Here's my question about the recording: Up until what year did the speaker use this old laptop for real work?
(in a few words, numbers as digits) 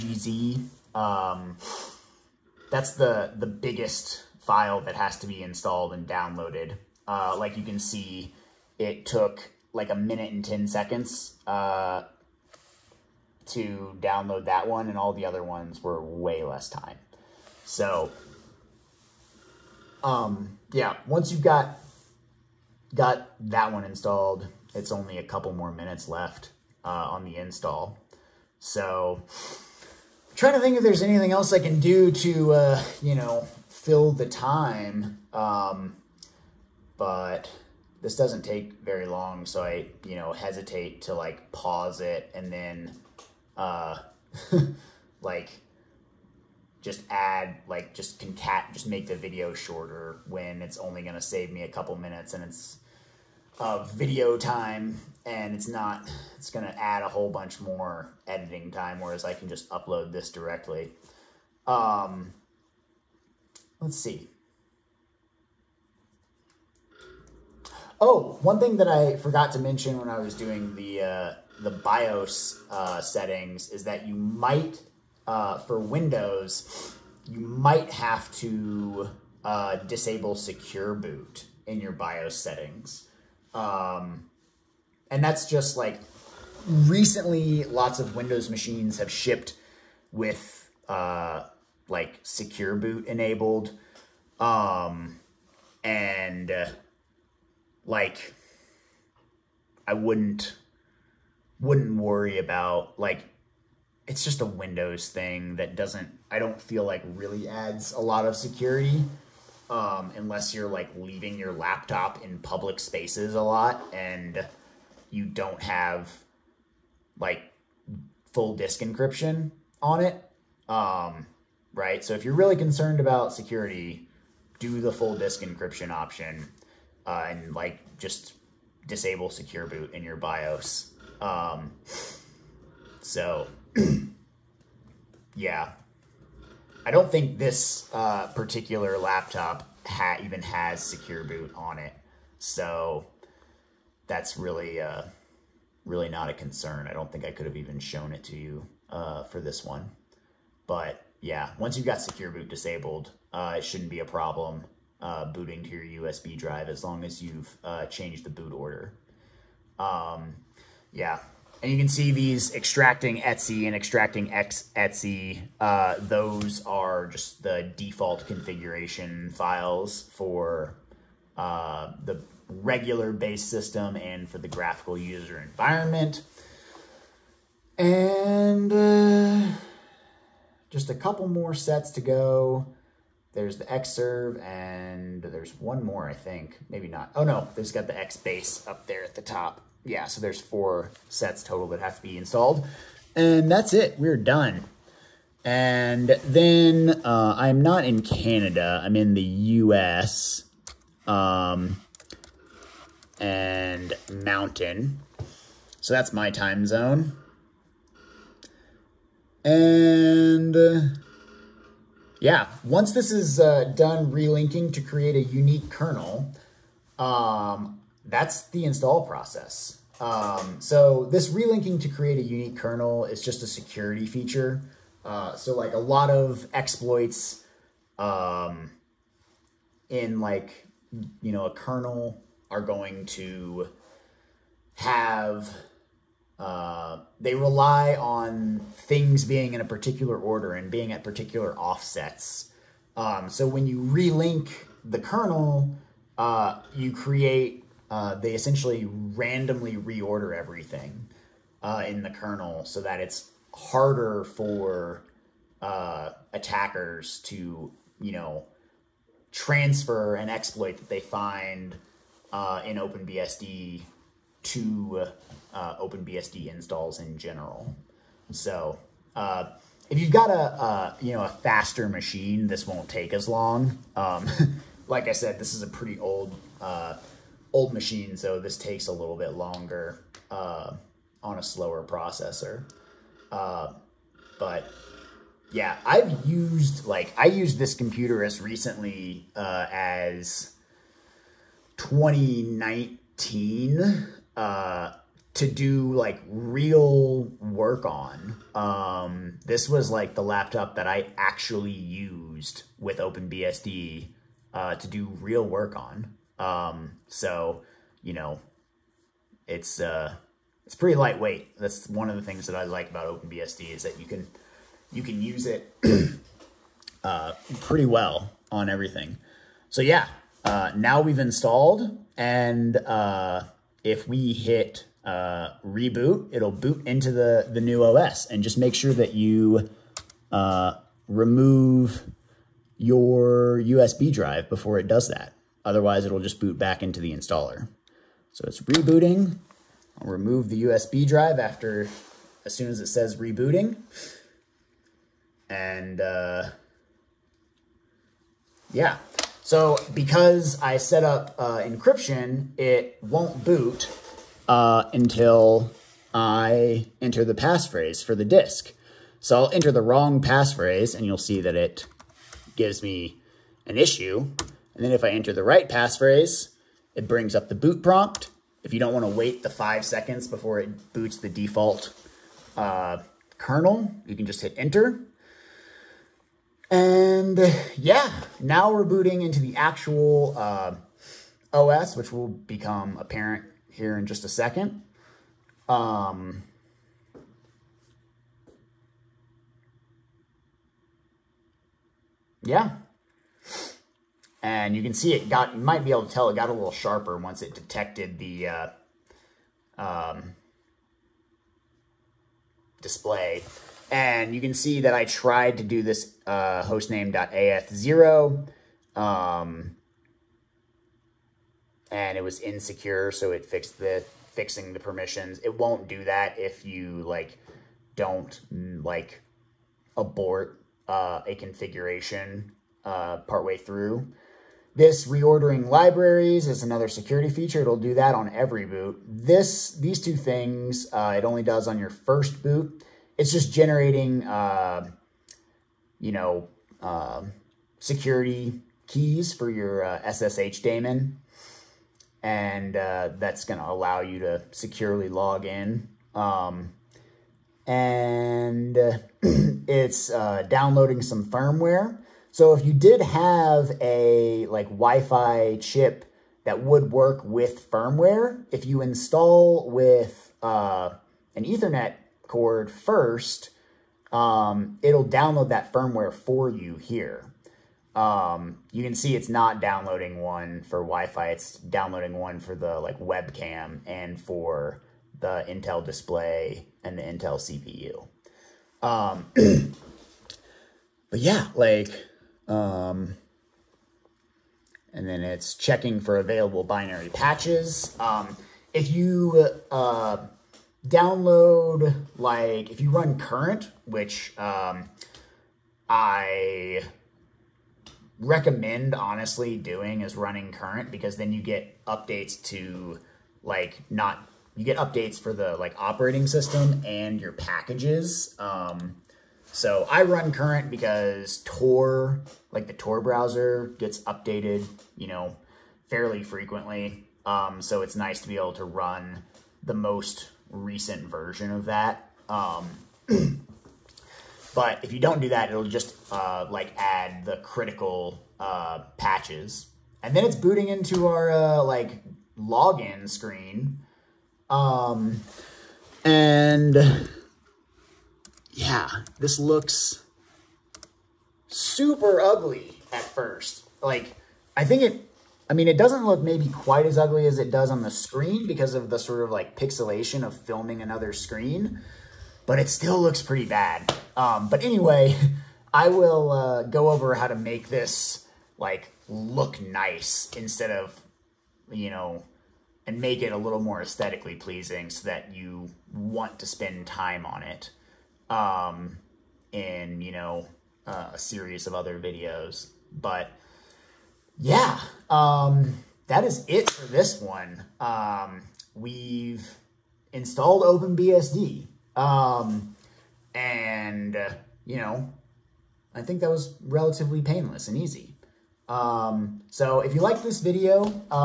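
2019.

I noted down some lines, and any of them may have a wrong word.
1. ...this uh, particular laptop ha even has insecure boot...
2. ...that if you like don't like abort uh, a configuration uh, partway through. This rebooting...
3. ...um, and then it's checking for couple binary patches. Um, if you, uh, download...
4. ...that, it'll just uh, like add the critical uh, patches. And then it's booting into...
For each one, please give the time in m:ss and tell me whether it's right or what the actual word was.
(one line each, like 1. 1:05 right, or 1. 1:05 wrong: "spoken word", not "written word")
1. 2:17 wrong: "secure", not "insecure"
2. 6:56 wrong: "reordering", not "rebooting"
3. 8:02 wrong: "available", not "couple"
4. 8:45 right.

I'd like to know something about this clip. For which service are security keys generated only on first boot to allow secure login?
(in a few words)
SSH daemon.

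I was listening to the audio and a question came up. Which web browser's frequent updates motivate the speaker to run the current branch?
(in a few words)
Tor Browser.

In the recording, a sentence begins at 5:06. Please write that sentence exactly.
Um, so, you know, it's uh, it's pretty lightweight.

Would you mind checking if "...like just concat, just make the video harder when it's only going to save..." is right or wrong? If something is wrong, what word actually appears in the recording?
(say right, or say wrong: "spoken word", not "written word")
wrong: "shorter", not "harder".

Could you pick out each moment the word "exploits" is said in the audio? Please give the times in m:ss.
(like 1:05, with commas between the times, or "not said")
3:46, 4:20.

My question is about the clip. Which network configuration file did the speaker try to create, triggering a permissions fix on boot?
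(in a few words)
hostname.af0.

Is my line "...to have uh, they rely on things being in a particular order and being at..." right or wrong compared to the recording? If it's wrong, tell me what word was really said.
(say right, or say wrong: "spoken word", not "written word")
right.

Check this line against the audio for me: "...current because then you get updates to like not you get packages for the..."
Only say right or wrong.
wrong.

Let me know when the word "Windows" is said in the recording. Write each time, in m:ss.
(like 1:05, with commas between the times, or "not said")
1:15, 1:28, 1:44.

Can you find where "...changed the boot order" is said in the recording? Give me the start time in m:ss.
2:37.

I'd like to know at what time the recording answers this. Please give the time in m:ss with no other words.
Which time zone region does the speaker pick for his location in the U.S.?
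3:24.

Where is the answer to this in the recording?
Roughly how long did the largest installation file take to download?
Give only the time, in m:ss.
0:09.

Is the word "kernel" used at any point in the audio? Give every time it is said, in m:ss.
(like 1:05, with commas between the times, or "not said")
3:35, 3:42, 3:51, 4:04, 4:12, 6:13.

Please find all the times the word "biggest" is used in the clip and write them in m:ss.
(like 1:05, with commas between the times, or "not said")
0:03.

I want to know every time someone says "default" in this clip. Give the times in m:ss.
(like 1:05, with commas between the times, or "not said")
2:47, 6:11.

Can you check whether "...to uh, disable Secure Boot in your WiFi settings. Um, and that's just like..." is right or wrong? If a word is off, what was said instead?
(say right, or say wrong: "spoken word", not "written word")
wrong: "BIOS", not "WiFi".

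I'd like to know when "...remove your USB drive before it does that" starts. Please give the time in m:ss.
5:31.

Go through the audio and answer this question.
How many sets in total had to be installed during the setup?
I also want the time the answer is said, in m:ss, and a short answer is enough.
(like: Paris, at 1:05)
4, at 3:10.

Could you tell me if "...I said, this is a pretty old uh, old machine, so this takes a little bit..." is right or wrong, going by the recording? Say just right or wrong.
right.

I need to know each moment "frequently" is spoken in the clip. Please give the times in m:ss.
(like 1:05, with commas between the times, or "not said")
8:36.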